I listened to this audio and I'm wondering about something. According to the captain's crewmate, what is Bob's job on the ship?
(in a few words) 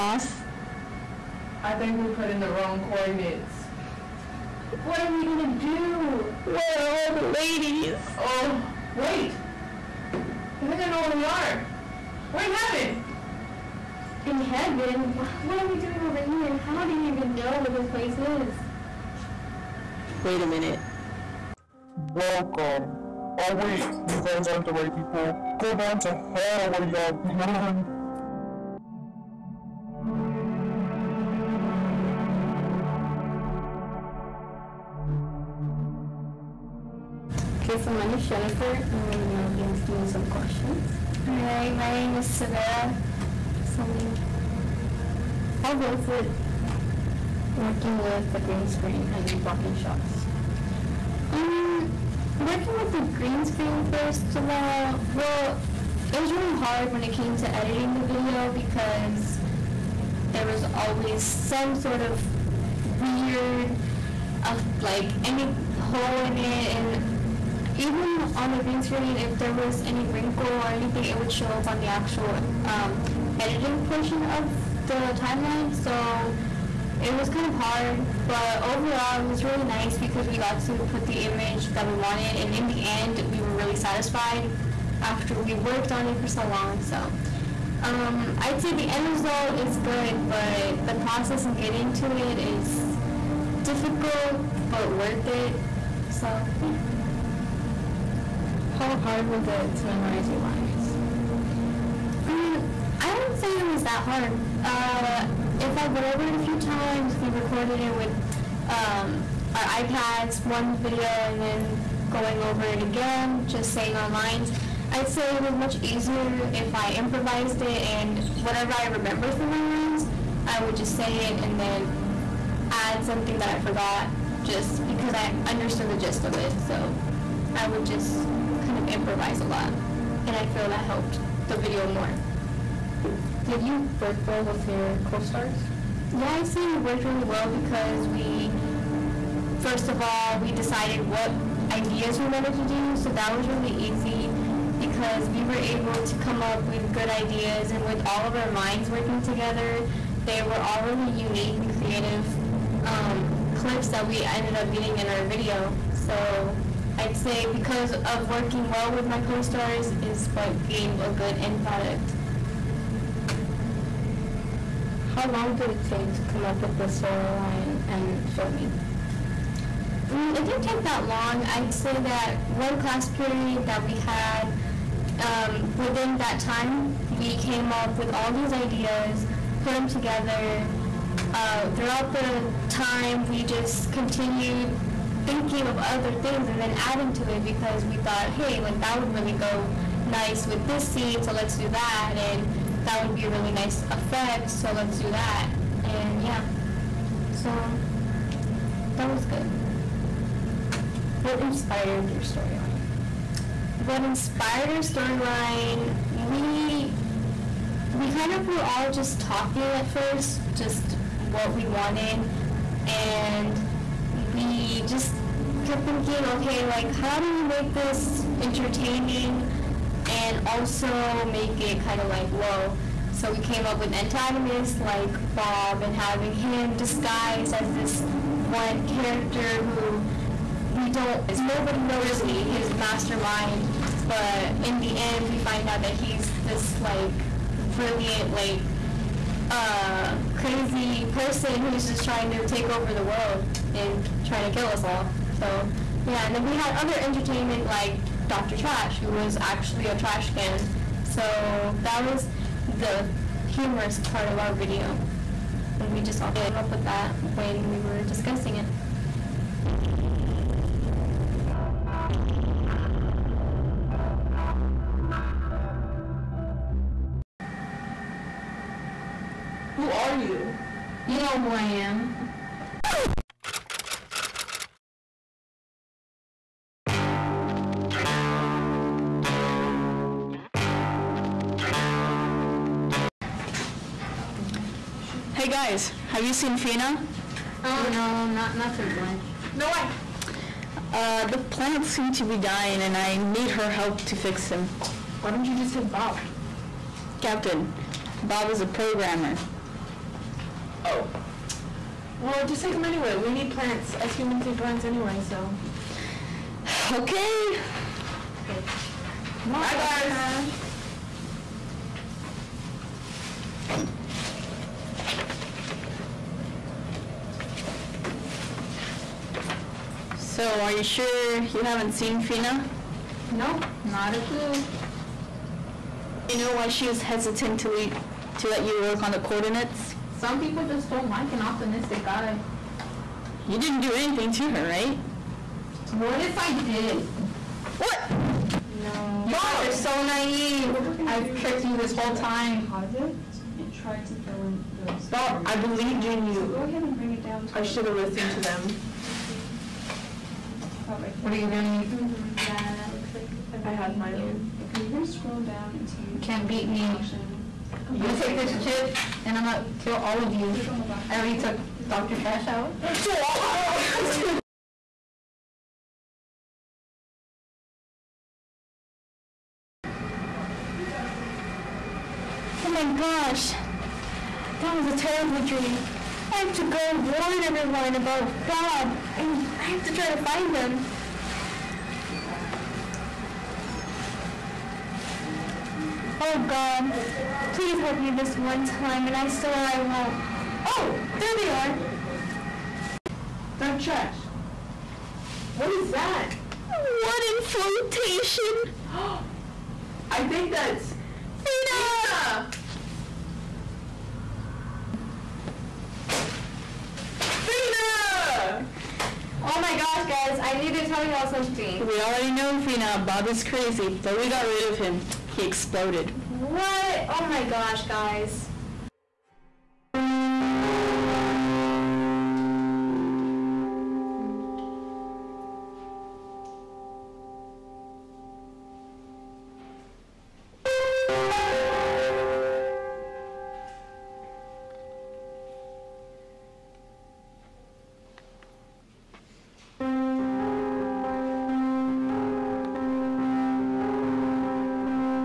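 Programmer.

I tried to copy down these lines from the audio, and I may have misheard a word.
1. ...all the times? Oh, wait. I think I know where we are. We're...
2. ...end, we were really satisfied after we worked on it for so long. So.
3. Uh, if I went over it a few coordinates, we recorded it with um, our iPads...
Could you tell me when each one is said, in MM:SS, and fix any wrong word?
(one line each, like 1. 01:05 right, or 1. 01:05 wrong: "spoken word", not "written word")
1. 00:06 wrong: "ladies", not "times"
2. 01:22 right
3. 01:44 wrong: "times", not "coordinates".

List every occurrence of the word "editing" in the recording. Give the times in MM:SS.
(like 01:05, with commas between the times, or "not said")
00:57, 01:13.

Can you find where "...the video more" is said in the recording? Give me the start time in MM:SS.
02:11.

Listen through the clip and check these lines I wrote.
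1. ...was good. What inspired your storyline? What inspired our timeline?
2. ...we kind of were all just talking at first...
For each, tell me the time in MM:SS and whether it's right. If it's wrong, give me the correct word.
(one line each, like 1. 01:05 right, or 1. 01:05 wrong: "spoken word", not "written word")
1. 03:19 wrong: "storyline", not "timeline"
2. 03:27 right.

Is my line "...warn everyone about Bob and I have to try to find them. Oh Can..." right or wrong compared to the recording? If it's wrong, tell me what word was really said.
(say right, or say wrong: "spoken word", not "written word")
wrong: "God", not "Can".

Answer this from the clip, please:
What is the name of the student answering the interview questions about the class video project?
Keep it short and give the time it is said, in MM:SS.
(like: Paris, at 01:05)
Severa, at 00:41.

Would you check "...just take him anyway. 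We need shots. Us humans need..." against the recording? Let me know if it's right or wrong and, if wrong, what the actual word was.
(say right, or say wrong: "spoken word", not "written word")
wrong: "plants", not "shots".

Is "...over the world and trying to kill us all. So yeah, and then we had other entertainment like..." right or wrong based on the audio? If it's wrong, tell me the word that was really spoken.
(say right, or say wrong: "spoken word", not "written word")
right.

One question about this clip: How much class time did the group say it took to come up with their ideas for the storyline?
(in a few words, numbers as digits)
One class period.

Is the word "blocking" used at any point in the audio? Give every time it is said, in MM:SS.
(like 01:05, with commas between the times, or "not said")
00:49.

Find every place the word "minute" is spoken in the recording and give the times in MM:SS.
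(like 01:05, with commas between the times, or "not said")
00:20.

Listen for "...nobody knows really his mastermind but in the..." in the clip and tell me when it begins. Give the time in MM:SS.
03:51.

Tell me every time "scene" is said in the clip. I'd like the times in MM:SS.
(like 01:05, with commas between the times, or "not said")
03:10.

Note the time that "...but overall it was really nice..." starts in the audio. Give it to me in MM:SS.
01:18.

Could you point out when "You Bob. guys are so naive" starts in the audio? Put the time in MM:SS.
05:39.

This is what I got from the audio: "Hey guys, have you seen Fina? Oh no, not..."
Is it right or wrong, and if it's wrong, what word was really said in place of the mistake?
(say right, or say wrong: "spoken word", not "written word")
right.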